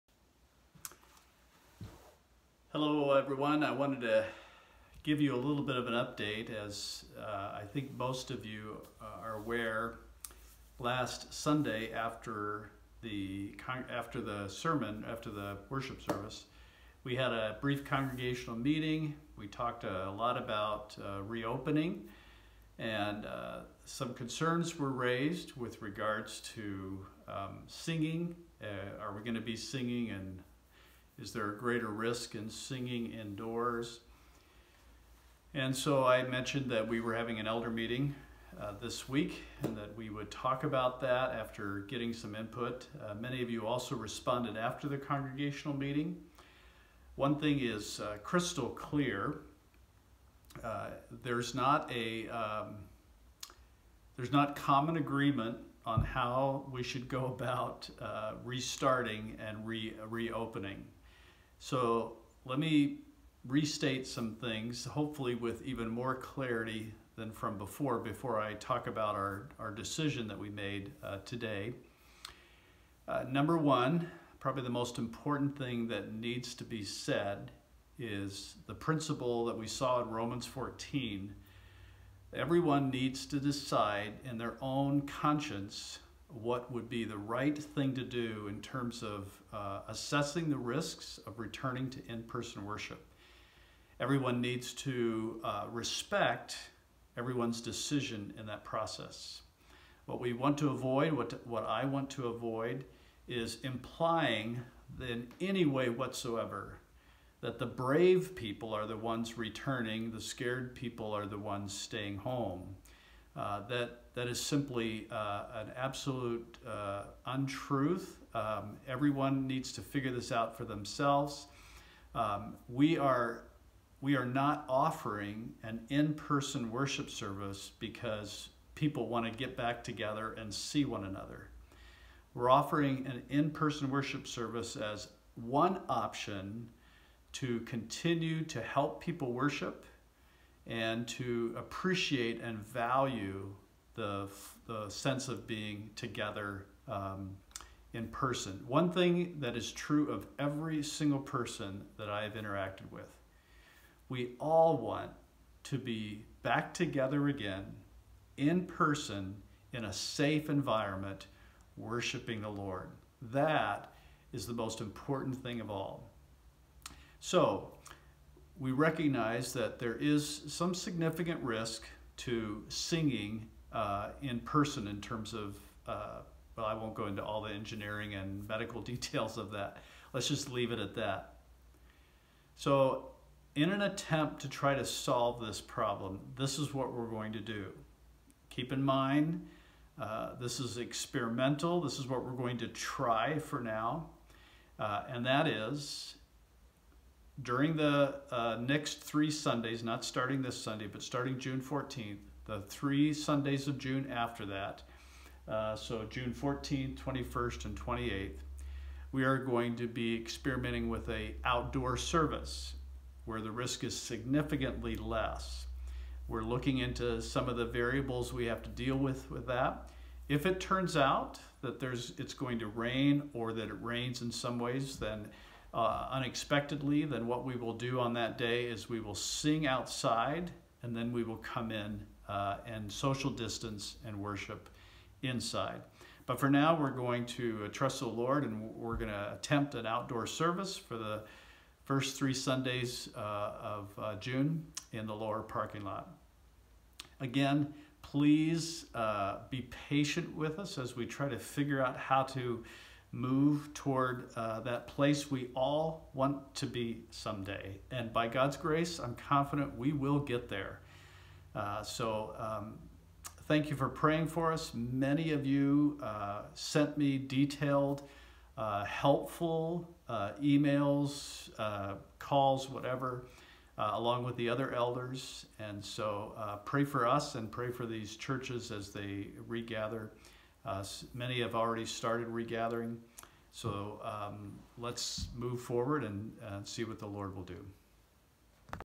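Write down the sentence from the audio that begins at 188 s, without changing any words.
Keep in mind, uh, this is experimental.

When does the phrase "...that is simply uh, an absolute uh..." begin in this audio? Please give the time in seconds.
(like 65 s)
114 s.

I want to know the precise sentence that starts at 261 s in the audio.
Uh, so um, thank you for praying for us.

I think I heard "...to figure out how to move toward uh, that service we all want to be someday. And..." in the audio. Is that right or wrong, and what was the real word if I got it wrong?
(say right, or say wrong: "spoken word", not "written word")
wrong: "place", not "service".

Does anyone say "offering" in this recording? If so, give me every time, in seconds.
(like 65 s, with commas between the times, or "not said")
124 s, 132 s.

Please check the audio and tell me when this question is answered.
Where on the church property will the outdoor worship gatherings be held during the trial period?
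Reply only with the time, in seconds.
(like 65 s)
245 s.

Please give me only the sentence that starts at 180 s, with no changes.
Let's just leave it at that.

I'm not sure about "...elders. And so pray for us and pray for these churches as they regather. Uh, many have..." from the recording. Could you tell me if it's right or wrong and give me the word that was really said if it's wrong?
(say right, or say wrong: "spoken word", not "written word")
right.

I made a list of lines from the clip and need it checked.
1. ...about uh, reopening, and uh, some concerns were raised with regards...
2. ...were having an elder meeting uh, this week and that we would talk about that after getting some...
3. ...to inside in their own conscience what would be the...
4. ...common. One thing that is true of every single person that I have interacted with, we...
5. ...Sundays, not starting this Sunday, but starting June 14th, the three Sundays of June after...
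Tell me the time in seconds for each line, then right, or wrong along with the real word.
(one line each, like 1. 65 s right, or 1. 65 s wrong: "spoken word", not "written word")
1. 20 s right
2. 36 s right
3. 83 s wrong: "decide", not "inside"
4. 148 s wrong: "person", not "common"
5. 199 s right.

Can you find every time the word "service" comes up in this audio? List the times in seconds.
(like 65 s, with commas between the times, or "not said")
16 s, 127 s, 134 s, 211 s, 240 s.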